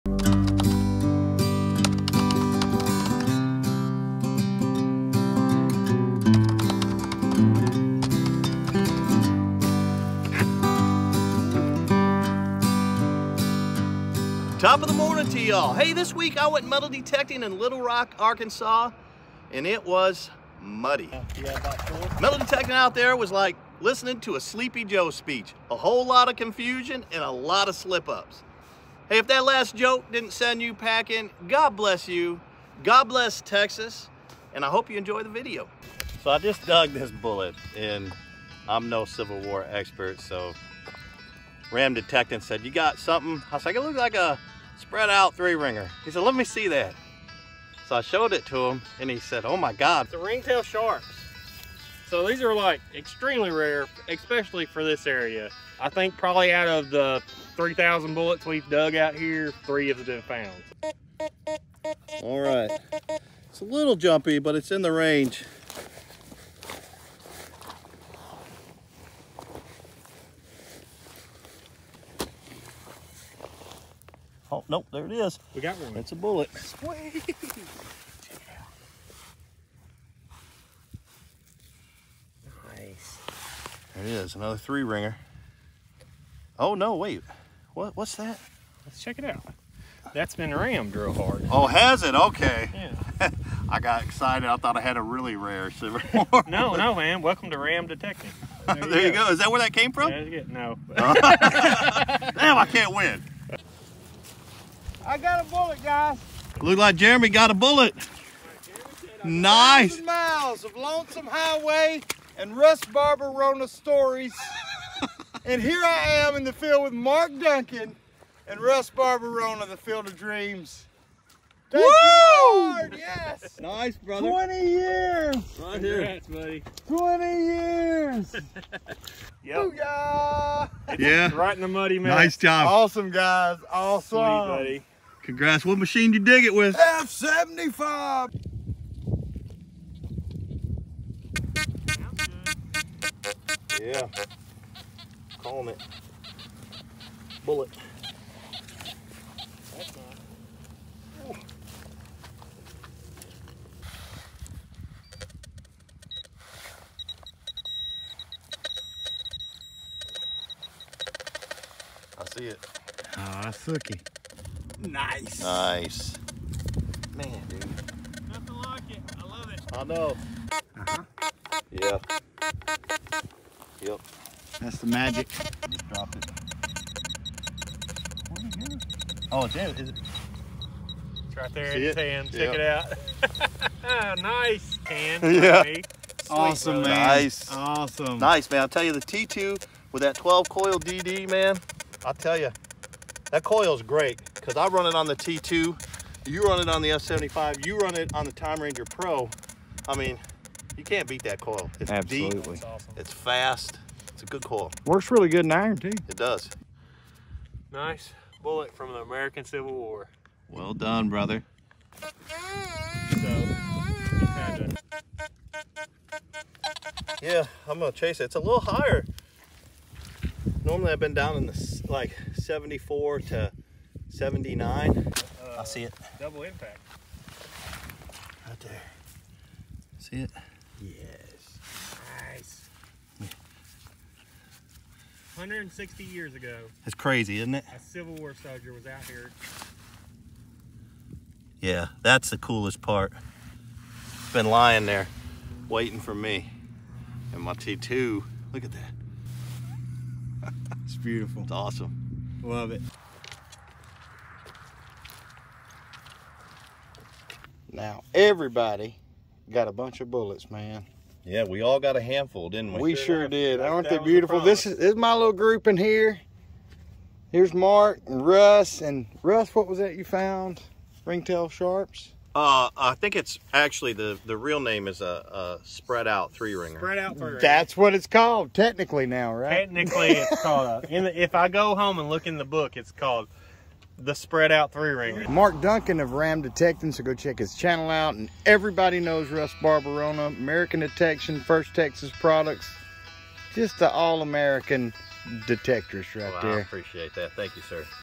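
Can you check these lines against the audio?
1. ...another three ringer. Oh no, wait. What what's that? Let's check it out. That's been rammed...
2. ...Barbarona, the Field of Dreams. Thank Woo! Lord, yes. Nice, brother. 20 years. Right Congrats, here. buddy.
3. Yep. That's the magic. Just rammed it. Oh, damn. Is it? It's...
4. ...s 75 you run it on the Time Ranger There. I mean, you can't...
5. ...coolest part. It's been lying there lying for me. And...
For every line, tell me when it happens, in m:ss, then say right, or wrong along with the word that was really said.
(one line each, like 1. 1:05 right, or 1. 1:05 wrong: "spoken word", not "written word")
1. 1:24 right
2. 1:58 right
3. 2:53 wrong: "dropped", not "rammed"
4. 3:16 wrong: "Pro", not "There"
5. 4:02 wrong: "waiting", not "lying".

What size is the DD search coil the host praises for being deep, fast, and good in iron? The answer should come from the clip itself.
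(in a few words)
12.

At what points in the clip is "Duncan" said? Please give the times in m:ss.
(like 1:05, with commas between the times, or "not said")
1:57, 4:45.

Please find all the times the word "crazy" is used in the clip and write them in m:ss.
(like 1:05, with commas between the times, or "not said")
3:56.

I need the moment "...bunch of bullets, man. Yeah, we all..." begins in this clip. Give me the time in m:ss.
4:19.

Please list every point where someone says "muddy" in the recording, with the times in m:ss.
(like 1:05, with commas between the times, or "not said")
0:20, 2:11.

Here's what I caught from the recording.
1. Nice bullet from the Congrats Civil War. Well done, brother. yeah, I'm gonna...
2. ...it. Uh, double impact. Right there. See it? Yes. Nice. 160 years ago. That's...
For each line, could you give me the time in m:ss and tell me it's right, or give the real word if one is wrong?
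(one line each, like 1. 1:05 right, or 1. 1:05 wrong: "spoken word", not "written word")
1. 3:27 wrong: "American", not "Congrats"
2. 3:45 right.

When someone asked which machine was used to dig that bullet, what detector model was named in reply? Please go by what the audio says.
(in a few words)
F-75.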